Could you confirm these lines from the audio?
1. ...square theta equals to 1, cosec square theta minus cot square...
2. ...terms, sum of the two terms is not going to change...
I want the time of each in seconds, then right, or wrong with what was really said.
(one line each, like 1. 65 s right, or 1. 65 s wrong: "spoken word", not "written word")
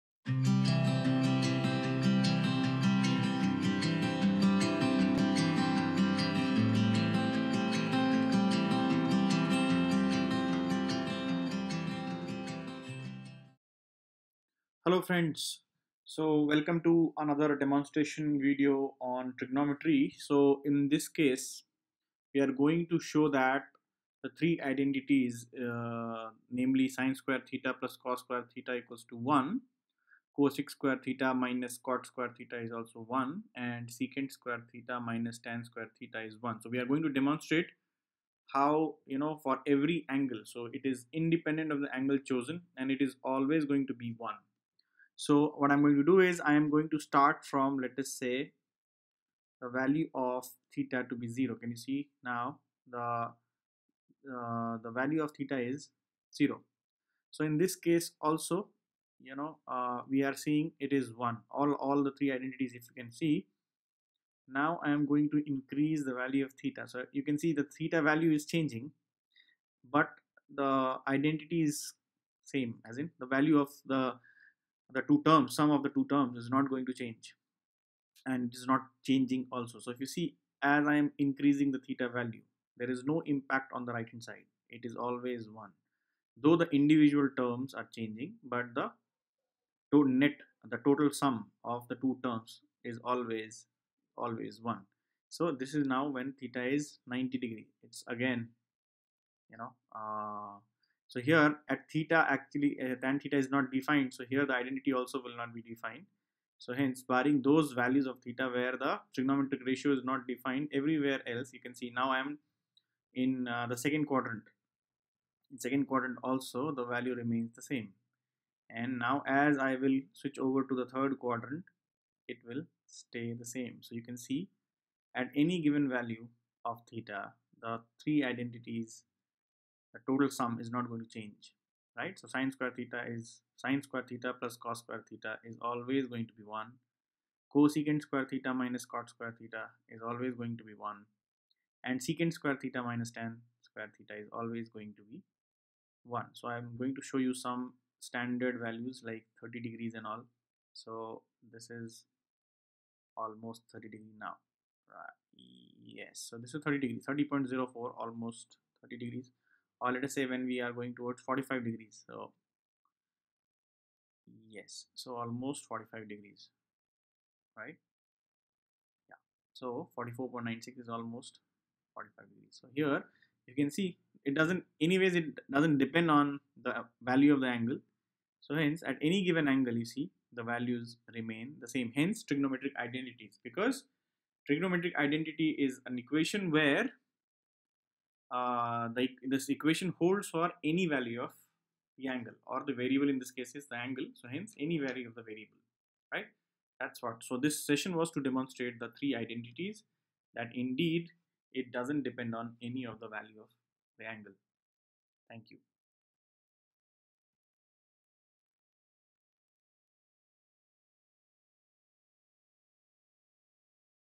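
1. 28 s right
2. 75 s right.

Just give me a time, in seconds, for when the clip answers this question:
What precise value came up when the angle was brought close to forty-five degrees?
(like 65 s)
169 s.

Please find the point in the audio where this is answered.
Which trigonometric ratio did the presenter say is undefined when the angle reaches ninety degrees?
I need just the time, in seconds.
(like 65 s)
103 s.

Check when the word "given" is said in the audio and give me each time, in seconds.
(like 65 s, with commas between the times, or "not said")
125 s, 179 s.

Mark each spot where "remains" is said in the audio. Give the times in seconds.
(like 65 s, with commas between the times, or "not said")
117 s, 181 s.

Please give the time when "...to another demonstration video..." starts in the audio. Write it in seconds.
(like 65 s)
16 s.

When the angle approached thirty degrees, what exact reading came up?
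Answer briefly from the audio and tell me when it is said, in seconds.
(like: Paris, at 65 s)
30.04, at 157 s.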